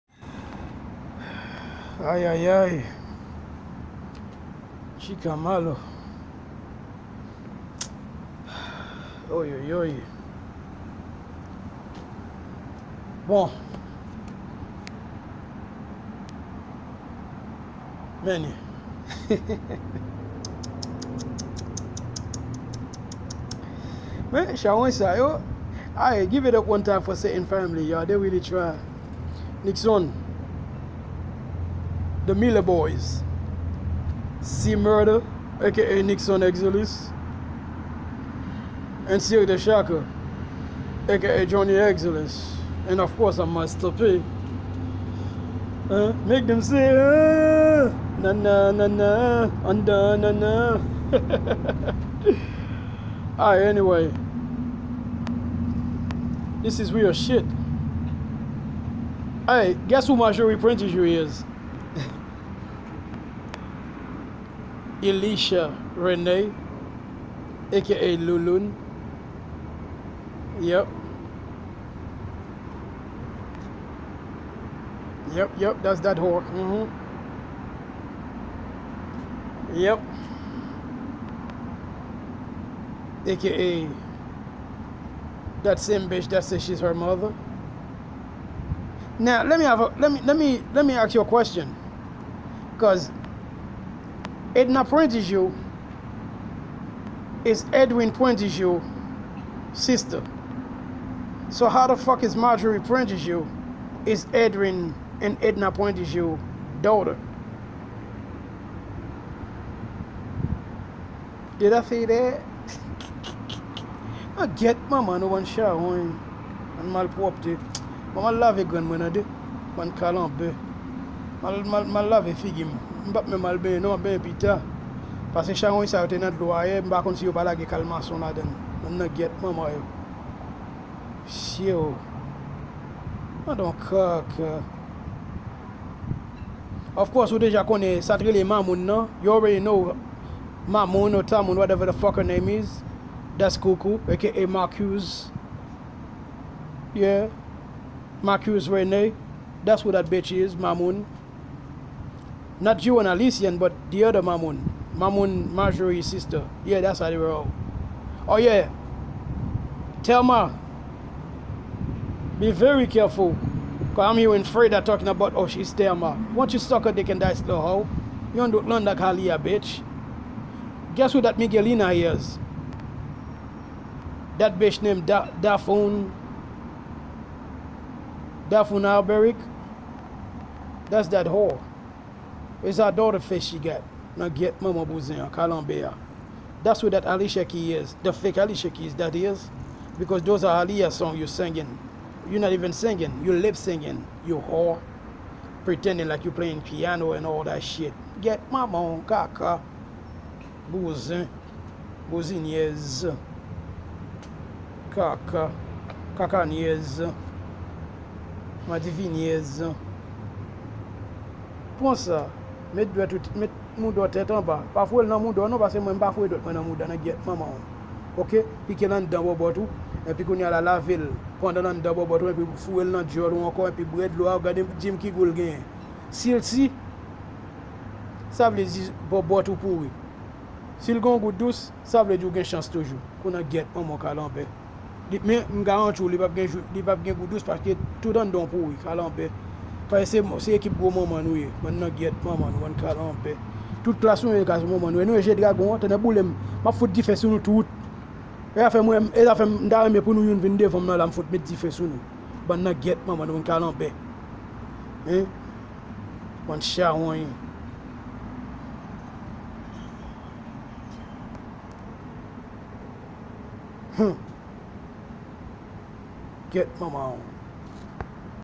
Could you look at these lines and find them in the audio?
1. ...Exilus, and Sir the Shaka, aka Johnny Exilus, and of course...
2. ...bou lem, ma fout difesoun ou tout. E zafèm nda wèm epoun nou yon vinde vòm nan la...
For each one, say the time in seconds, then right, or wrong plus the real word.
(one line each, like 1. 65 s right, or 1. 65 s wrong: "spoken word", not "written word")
1. 36 s right
2. 245 s right.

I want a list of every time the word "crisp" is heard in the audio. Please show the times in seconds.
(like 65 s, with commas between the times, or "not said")
not said.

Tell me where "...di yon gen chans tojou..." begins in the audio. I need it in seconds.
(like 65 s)
232 s.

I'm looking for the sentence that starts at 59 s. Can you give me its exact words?
Hey, guess who my jury printed you is?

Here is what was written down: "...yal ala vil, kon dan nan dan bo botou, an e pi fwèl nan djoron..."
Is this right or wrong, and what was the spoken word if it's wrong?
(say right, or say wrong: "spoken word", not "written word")
right.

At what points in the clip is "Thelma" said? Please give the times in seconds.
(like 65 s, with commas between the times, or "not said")
160 s, 165 s.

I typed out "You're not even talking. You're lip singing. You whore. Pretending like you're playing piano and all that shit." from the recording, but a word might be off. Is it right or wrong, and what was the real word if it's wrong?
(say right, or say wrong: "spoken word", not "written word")
wrong: "singing", not "talking".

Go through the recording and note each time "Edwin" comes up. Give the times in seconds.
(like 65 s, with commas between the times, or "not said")
97 s, 104 s.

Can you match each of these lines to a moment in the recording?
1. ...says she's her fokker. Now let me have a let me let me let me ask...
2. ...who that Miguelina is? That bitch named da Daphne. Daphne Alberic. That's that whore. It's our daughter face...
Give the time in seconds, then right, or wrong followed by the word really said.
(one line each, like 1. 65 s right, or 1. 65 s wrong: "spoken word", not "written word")
1. 86 s wrong: "mother", not "fokker"
2. 171 s right.